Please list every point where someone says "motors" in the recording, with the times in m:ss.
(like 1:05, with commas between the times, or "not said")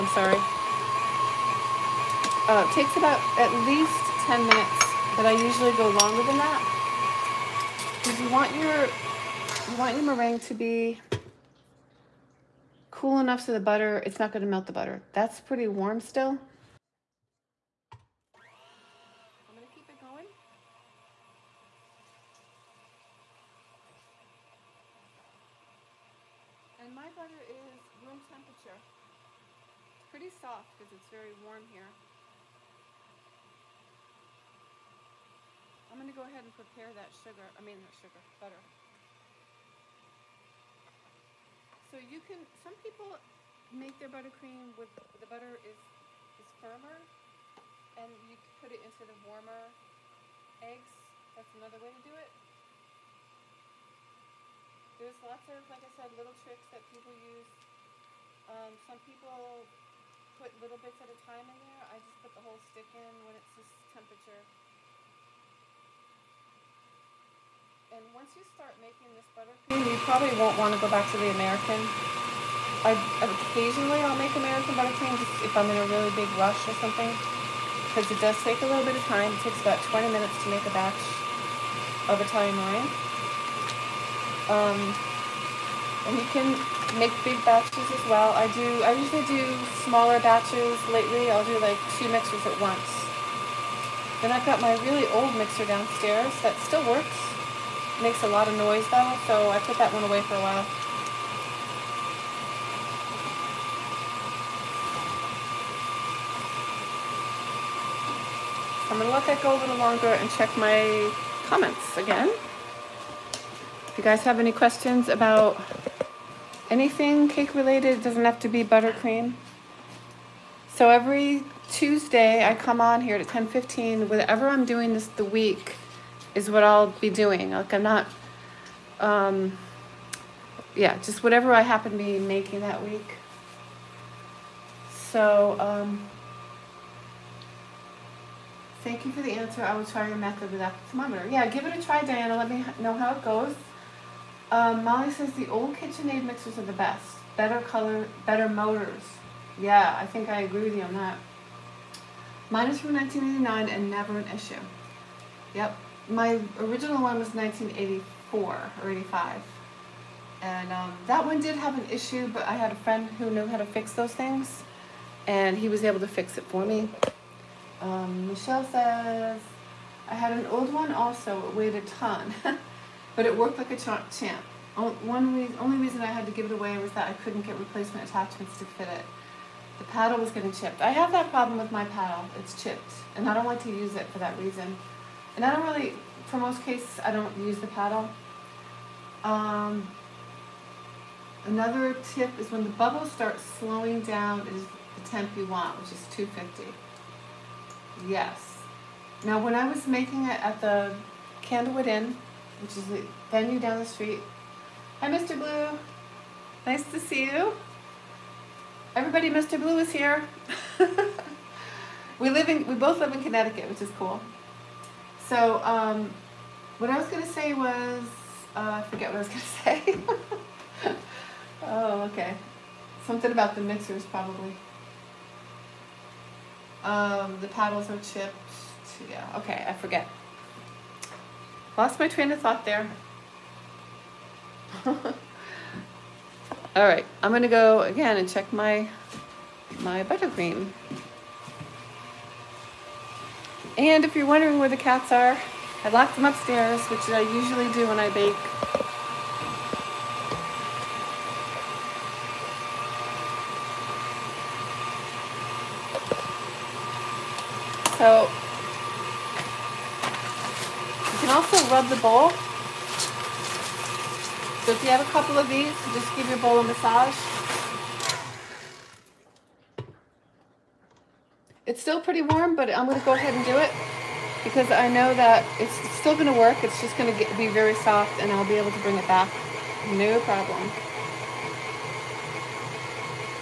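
2:28.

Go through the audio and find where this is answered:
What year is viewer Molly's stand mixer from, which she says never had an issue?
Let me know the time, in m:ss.
2:32.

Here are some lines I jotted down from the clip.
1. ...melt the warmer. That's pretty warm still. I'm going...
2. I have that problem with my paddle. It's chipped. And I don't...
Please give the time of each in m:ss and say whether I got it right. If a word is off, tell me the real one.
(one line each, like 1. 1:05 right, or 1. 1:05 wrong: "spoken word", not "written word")
1. 0:14 wrong: "butter", not "warmer"
2. 3:00 right.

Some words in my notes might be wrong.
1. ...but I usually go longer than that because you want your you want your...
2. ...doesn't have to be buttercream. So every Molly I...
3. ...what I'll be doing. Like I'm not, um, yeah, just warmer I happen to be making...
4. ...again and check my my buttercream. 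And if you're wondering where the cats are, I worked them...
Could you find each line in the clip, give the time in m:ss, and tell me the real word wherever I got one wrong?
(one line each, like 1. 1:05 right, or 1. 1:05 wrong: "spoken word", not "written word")
1. 0:05 right
2. 1:58 wrong: "Tuesday", not "Molly"
3. 2:06 wrong: "whatever", not "warmer"
4. 3:57 wrong: "locked", not "worked".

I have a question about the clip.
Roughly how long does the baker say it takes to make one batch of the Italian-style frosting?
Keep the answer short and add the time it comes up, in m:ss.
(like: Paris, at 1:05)
20 minutes, at 1:19.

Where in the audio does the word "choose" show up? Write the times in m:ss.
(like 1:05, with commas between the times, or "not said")
not said.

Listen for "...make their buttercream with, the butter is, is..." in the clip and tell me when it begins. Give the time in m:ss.
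0:43.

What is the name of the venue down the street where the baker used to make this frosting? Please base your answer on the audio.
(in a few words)
Candlewood Inn.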